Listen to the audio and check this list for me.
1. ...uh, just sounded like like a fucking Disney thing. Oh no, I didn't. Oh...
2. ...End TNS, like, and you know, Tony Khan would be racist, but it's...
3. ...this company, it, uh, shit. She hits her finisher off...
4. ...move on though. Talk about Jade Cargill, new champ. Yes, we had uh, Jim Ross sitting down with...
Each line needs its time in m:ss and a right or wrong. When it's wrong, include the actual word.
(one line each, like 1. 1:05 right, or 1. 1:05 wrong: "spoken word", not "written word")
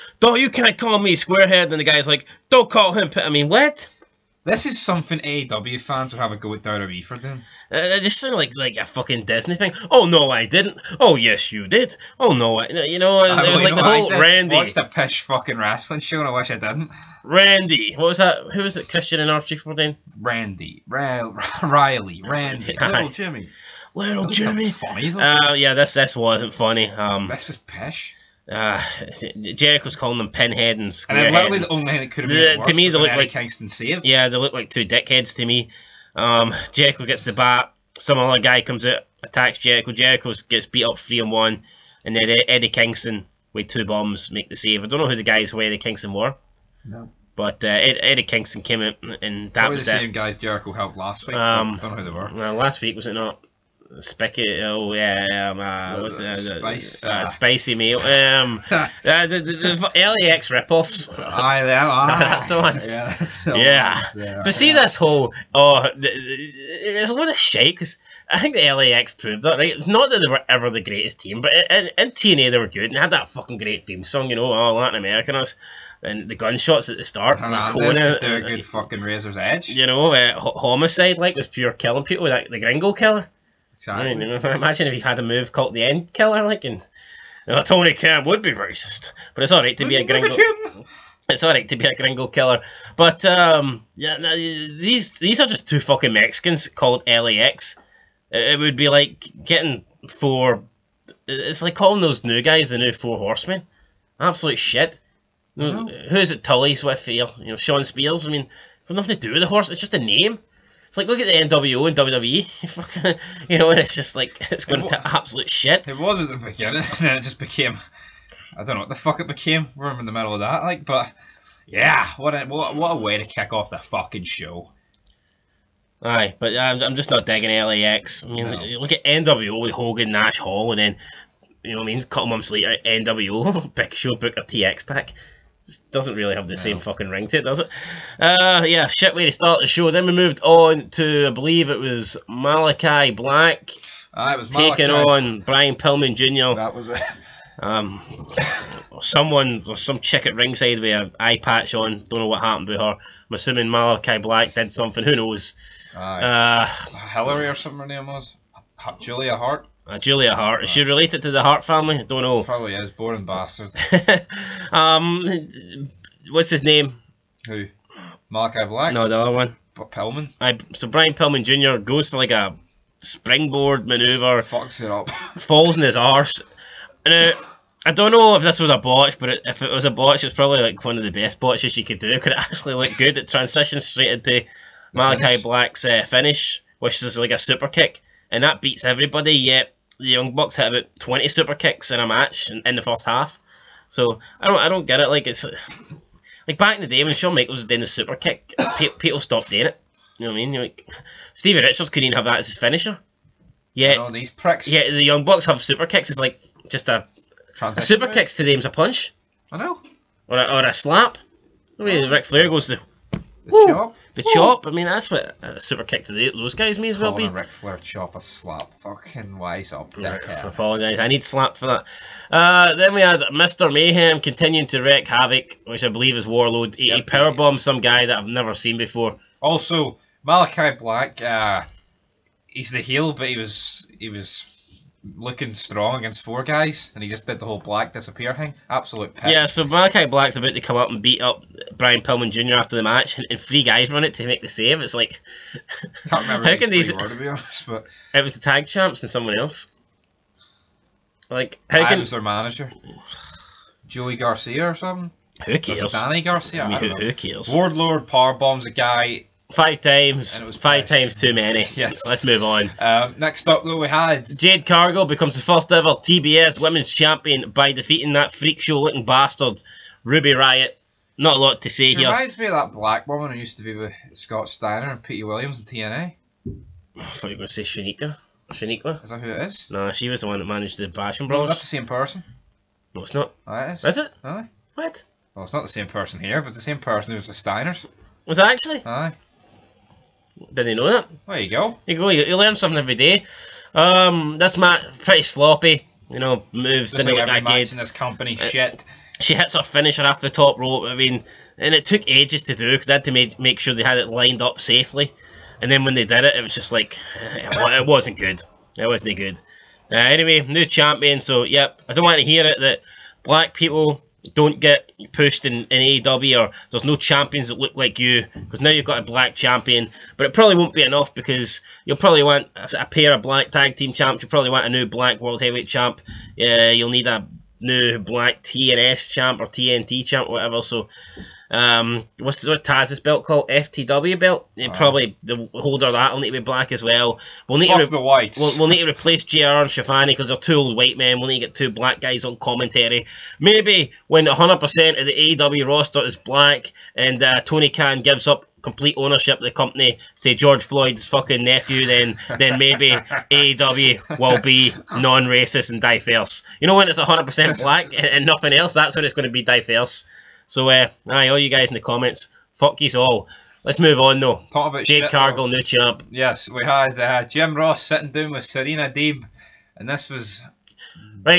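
1. 0:07 right
2. 1:25 wrong: "Killer", not "TNS"
3. 4:57 right
4. 6:03 right.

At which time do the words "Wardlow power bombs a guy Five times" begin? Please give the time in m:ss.
4:17.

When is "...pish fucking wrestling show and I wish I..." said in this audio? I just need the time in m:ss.
0:14.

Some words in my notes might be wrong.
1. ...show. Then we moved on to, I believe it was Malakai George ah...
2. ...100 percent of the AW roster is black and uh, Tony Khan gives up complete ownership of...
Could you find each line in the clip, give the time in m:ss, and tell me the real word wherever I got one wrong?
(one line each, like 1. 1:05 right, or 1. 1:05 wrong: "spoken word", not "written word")
1. 2:19 wrong: "Black", not "George"
2. 5:44 right.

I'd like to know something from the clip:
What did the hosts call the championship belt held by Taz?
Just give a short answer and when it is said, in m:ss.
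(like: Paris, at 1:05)
FTW belt, at 5:33.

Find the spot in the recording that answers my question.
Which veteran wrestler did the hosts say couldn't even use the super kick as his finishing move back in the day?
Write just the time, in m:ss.
3:21.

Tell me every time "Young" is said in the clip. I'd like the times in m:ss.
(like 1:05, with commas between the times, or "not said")
3:10, 3:25.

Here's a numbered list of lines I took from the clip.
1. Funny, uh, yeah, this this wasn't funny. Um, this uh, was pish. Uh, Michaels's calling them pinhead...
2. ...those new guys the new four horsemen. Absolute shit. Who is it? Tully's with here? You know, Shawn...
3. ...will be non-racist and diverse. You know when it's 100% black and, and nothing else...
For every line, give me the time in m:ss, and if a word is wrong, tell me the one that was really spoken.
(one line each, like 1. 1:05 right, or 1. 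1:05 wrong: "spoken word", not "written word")
1. 0:24 wrong: "Jericho", not "Michaels"
2. 1:42 right
3. 5:54 right.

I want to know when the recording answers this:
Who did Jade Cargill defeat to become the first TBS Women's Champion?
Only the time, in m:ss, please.
4:30.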